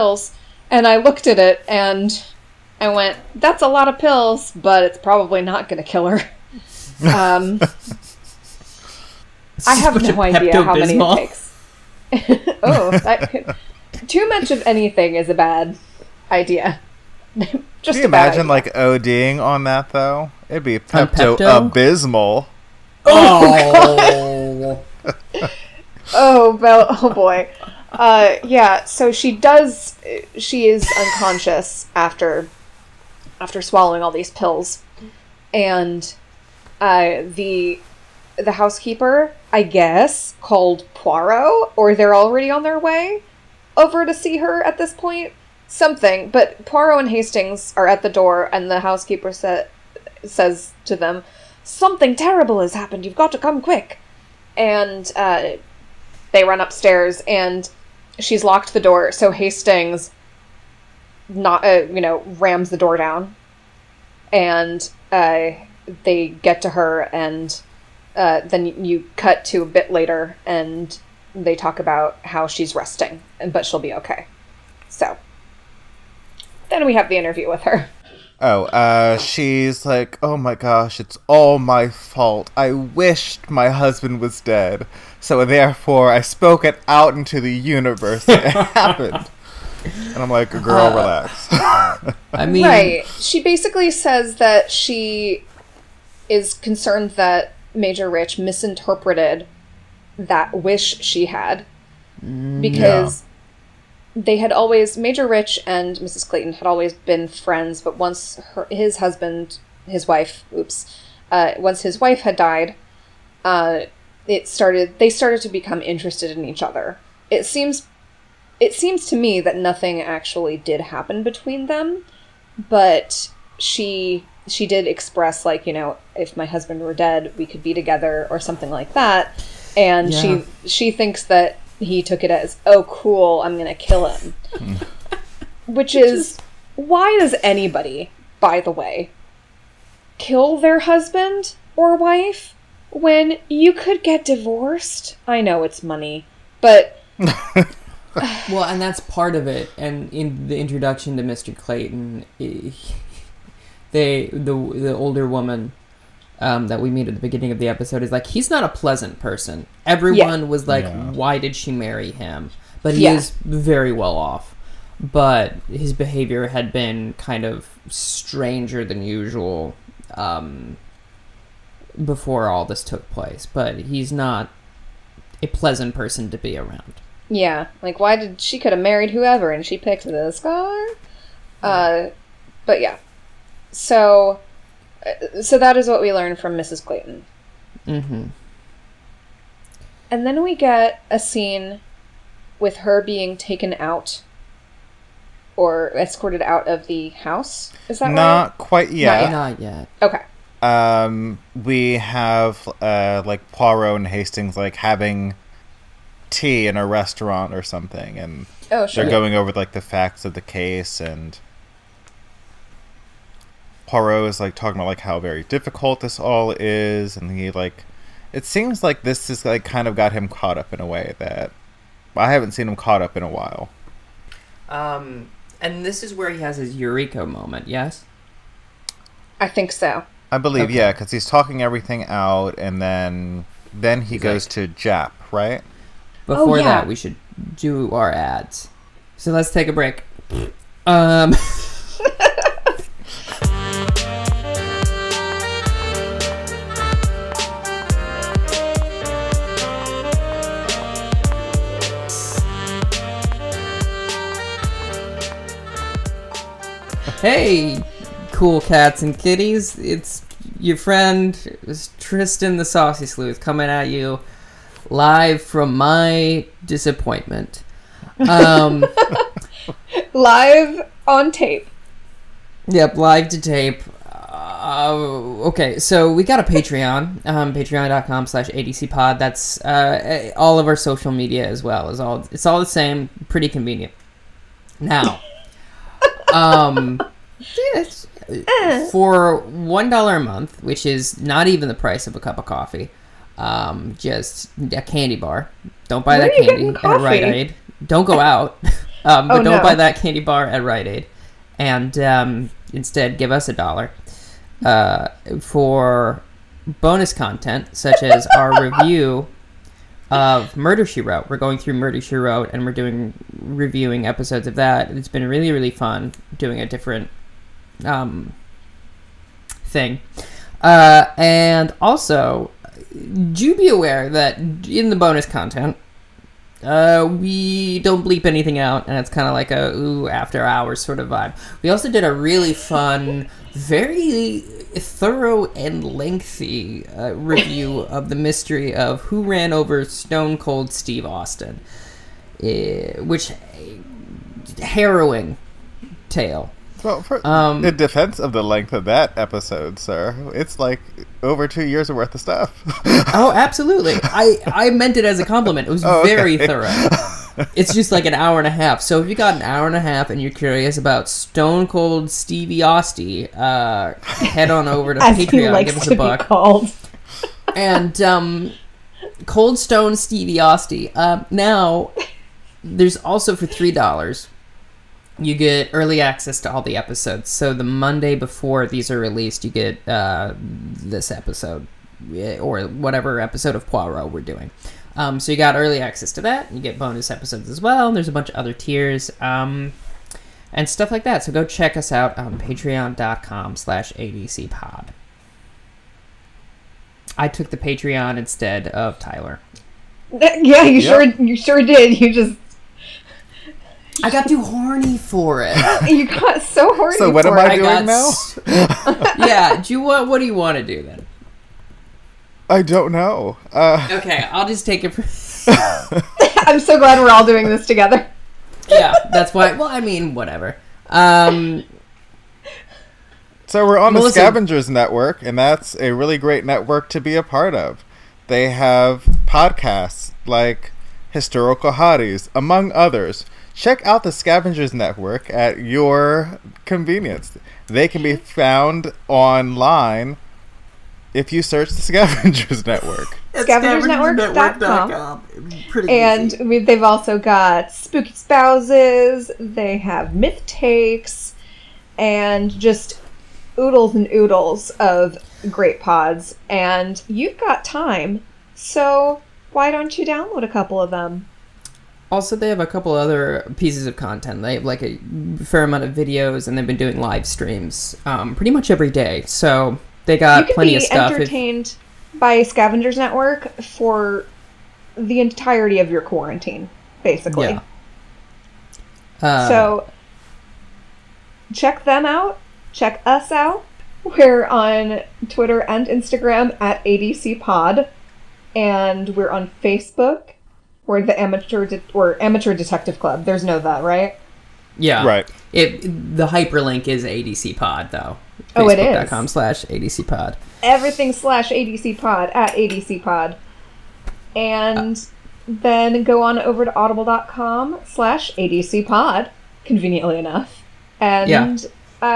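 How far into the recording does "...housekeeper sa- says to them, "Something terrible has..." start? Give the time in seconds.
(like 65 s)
48 s.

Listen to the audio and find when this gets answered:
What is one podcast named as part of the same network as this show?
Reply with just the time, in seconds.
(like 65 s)
431 s.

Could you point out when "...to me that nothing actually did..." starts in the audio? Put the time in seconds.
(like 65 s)
119 s.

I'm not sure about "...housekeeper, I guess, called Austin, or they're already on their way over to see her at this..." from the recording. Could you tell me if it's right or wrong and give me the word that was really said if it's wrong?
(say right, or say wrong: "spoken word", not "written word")
wrong: "Poirot", not "Austin".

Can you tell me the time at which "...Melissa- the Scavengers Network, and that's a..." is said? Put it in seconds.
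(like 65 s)
423 s.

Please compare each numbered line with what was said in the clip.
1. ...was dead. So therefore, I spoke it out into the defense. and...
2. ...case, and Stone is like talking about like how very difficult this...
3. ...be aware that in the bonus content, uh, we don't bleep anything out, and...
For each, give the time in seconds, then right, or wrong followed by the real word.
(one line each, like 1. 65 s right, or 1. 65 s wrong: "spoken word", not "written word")
1. 84 s wrong: "universe", not "defense"
2. 210 s wrong: "Poirot", not "Stone"
3. 323 s right.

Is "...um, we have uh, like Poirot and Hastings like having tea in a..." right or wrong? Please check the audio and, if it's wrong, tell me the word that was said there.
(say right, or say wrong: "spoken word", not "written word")
right.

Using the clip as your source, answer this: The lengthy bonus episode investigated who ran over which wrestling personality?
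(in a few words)
Stone Cold Steve Austin.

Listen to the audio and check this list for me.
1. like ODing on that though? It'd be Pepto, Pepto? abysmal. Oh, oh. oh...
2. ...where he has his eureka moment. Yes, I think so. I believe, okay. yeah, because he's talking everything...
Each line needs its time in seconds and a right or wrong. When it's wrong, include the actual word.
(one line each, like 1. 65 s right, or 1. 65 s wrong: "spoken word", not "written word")
1. 18 s right
2. 226 s right.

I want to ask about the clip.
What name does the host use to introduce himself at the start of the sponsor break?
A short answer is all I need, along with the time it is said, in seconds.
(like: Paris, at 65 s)
Tristan the Saucy Sleuth, at 261 s.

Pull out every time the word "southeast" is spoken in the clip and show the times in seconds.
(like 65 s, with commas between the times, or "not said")
not said.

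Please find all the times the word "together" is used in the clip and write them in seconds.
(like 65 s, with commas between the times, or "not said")
127 s, 417 s.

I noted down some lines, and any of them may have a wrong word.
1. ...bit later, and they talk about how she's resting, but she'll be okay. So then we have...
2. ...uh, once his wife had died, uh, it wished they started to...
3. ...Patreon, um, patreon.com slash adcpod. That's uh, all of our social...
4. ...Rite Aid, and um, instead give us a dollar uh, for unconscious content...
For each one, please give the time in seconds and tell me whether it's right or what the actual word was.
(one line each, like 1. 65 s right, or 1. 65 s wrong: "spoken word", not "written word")
1. 69 s right
2. 111 s wrong: "started", not "wished"
3. 276 s right
4. 300 s wrong: "bonus", not "unconscious".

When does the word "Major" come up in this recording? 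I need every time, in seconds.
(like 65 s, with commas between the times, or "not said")
97 s, 104 s.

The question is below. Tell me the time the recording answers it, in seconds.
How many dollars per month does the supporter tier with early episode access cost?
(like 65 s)
373 s.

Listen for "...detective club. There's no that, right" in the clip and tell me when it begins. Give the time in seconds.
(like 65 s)
492 s.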